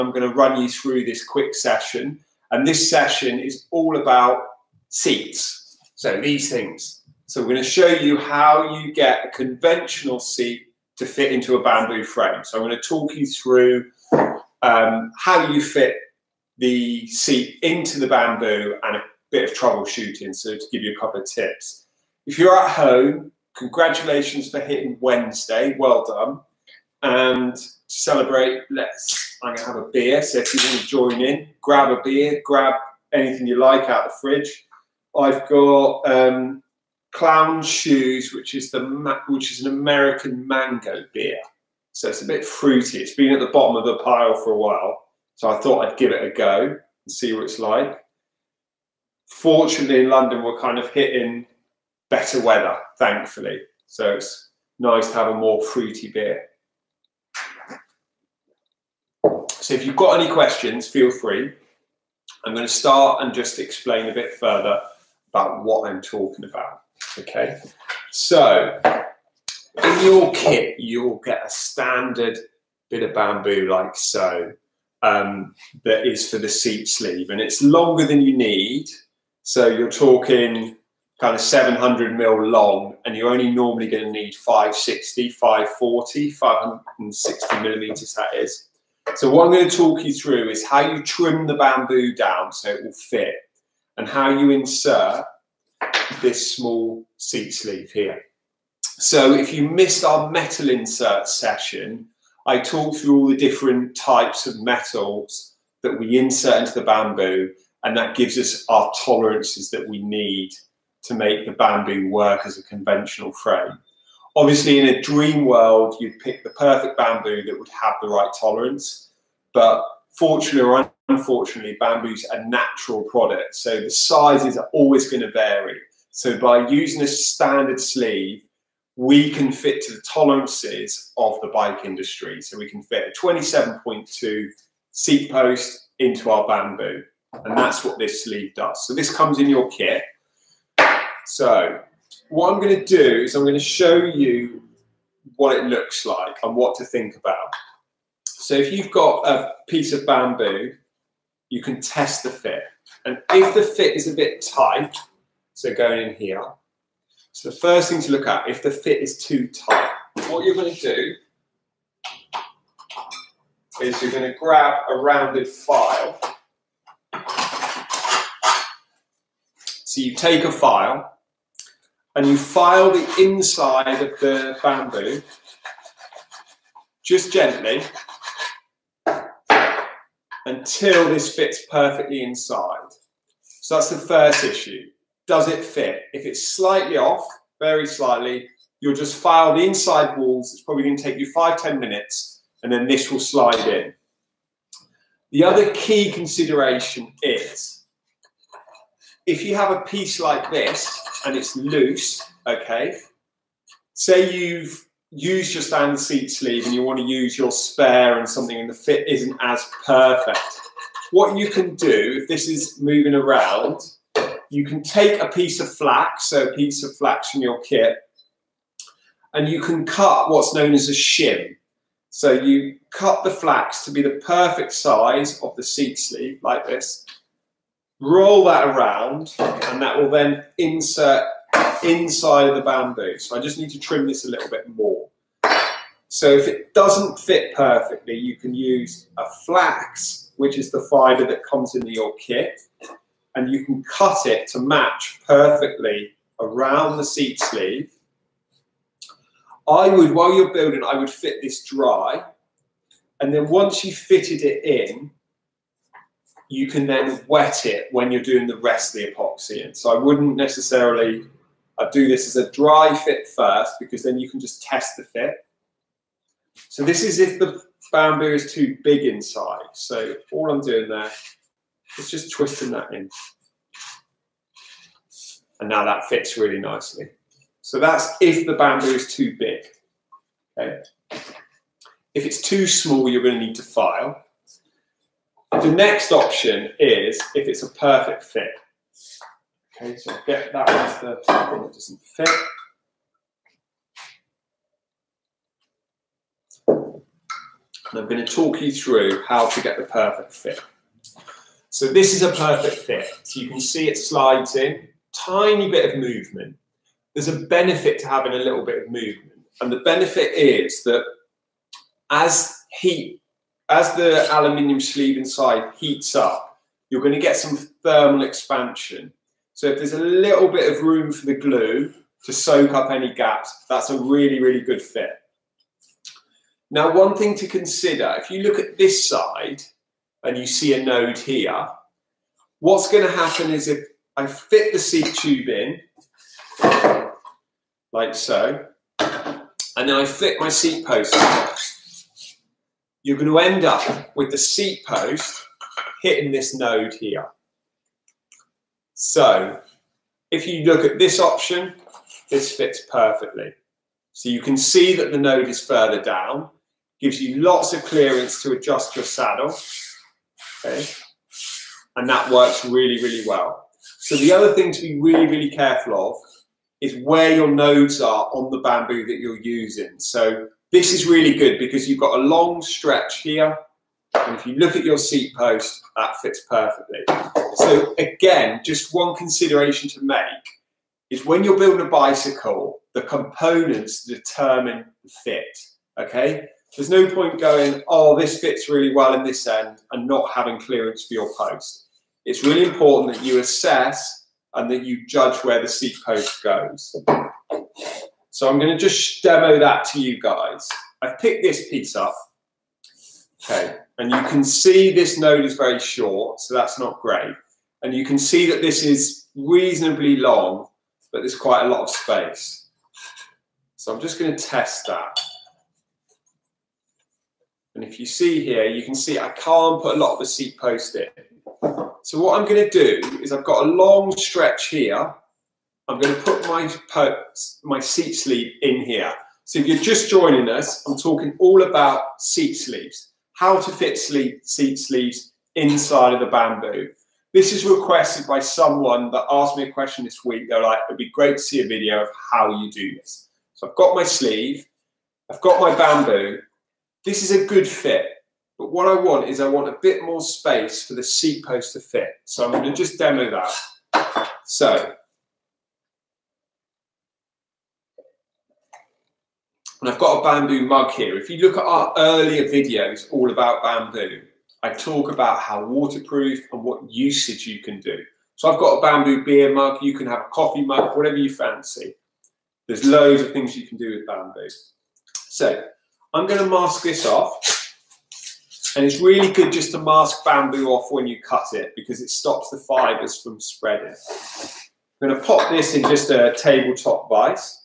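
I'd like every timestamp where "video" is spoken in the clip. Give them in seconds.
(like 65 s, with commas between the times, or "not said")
441 s, 462 s.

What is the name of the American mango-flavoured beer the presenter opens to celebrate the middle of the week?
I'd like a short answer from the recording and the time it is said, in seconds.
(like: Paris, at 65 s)
Clown Shoes, at 37 s.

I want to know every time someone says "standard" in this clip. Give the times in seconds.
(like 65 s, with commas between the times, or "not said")
71 s, 127 s, 205 s.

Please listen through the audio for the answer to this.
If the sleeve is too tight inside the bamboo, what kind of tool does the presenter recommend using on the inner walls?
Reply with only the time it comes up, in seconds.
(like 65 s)
164 s.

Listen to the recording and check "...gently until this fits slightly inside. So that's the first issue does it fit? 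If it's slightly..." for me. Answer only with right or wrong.
wrong.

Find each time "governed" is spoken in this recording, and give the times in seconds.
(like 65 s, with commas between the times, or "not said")
not said.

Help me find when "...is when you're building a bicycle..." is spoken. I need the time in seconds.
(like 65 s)
381 s.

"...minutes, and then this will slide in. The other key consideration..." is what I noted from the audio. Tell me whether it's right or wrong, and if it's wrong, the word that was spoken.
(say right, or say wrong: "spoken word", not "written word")
right.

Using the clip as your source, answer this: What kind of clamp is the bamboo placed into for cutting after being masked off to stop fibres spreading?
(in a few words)
tabletop vise.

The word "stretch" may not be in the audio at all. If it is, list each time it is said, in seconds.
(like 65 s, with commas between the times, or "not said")
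372 s, 424 s.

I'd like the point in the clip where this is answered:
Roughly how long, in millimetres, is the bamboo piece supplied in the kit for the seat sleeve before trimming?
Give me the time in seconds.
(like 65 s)
81 s.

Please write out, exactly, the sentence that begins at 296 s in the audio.
And I'm going to talk you through how to get the perfect fit.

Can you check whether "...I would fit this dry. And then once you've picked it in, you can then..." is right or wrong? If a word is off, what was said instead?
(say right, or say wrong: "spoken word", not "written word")
wrong: "fitted", not "picked".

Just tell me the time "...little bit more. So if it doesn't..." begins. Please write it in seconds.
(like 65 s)
234 s.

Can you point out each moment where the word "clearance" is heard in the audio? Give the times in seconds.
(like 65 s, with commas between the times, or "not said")
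357 s, 390 s.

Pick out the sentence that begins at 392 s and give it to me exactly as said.
It's really important that you assess and that you judge where the seat post goes.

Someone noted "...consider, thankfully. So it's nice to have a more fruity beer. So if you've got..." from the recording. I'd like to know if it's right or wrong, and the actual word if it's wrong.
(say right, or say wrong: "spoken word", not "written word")
wrong: "weather", not "consider".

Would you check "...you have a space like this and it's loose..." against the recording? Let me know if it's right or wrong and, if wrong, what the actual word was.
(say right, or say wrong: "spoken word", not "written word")
wrong: "piece", not "space".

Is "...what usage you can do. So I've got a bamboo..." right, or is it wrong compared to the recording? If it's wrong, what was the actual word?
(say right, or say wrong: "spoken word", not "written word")
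right.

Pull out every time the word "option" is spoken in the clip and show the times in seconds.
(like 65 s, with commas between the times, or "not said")
286 s, 351 s.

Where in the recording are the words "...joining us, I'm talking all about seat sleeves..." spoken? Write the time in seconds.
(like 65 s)
430 s.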